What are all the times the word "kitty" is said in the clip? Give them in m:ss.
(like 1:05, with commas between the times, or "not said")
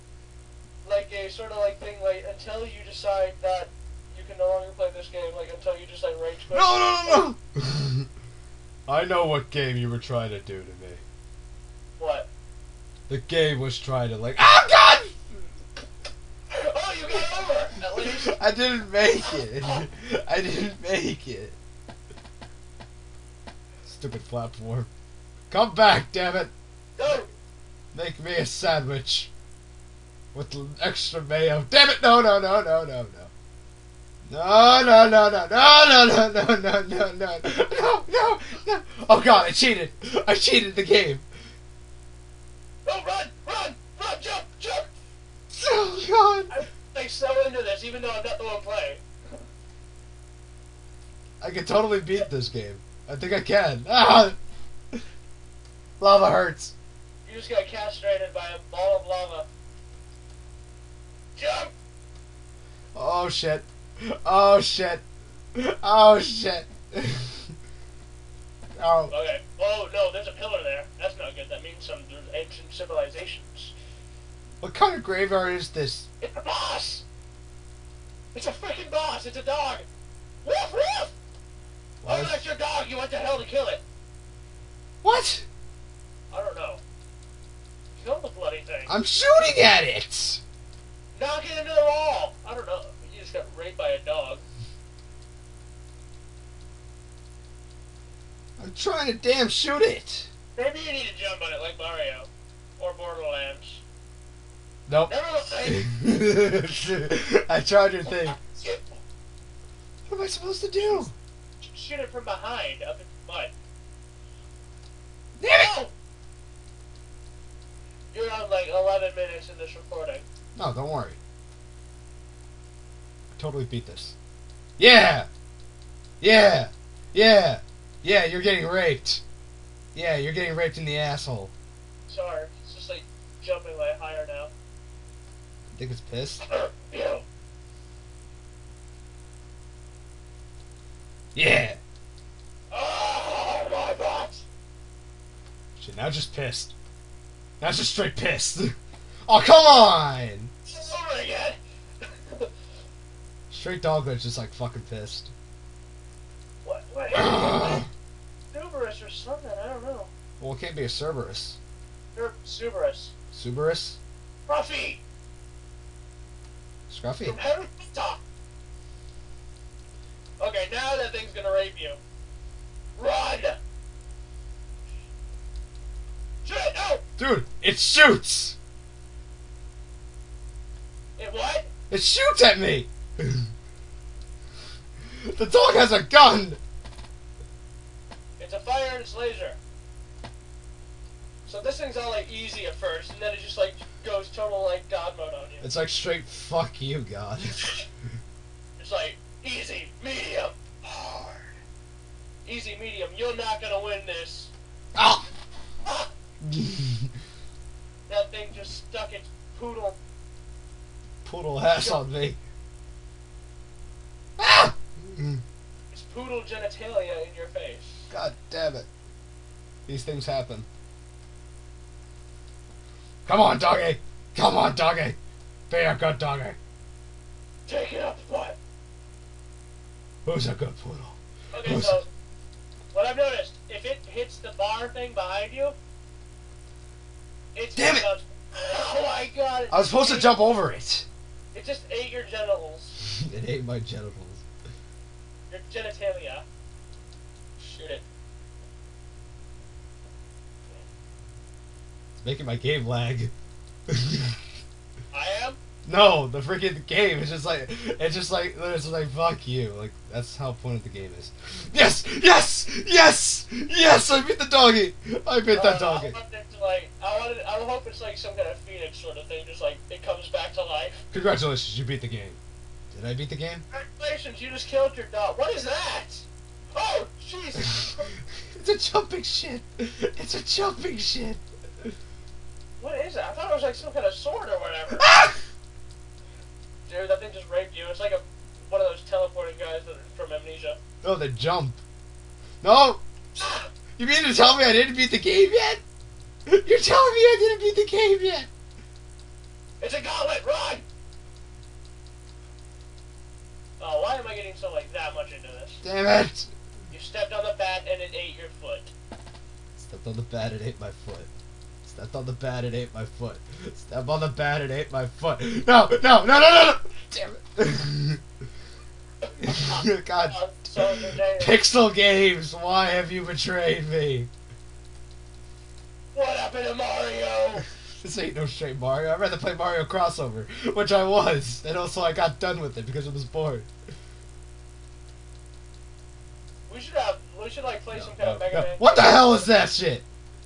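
not said.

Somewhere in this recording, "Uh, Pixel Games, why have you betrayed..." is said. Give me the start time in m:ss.
5:20.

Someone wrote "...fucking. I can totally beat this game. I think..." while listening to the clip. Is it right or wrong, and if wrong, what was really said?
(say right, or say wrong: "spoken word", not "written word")
wrong: "playing", not "fucking".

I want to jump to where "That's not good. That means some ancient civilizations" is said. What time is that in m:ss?
1:10.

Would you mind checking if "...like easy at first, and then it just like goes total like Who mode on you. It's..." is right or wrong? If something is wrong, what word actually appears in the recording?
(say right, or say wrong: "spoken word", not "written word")
wrong: "God", not "Who".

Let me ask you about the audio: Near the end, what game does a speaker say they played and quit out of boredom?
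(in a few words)
Mario Crossover.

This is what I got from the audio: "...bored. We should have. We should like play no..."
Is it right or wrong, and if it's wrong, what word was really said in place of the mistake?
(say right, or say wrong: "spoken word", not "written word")
right.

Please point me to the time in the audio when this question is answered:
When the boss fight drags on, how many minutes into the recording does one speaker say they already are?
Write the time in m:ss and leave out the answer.
1:58.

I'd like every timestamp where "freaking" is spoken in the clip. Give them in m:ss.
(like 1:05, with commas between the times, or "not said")
1:18, 4:16.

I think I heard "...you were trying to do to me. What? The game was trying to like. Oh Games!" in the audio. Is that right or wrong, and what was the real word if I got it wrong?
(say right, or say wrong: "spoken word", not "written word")
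wrong: "God", not "Games".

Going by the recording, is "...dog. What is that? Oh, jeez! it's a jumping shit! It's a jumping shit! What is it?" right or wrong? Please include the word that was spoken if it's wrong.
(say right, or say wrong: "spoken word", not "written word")
right.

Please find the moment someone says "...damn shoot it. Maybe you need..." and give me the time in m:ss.
1:39.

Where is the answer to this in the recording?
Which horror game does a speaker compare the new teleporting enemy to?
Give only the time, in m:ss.
4:50.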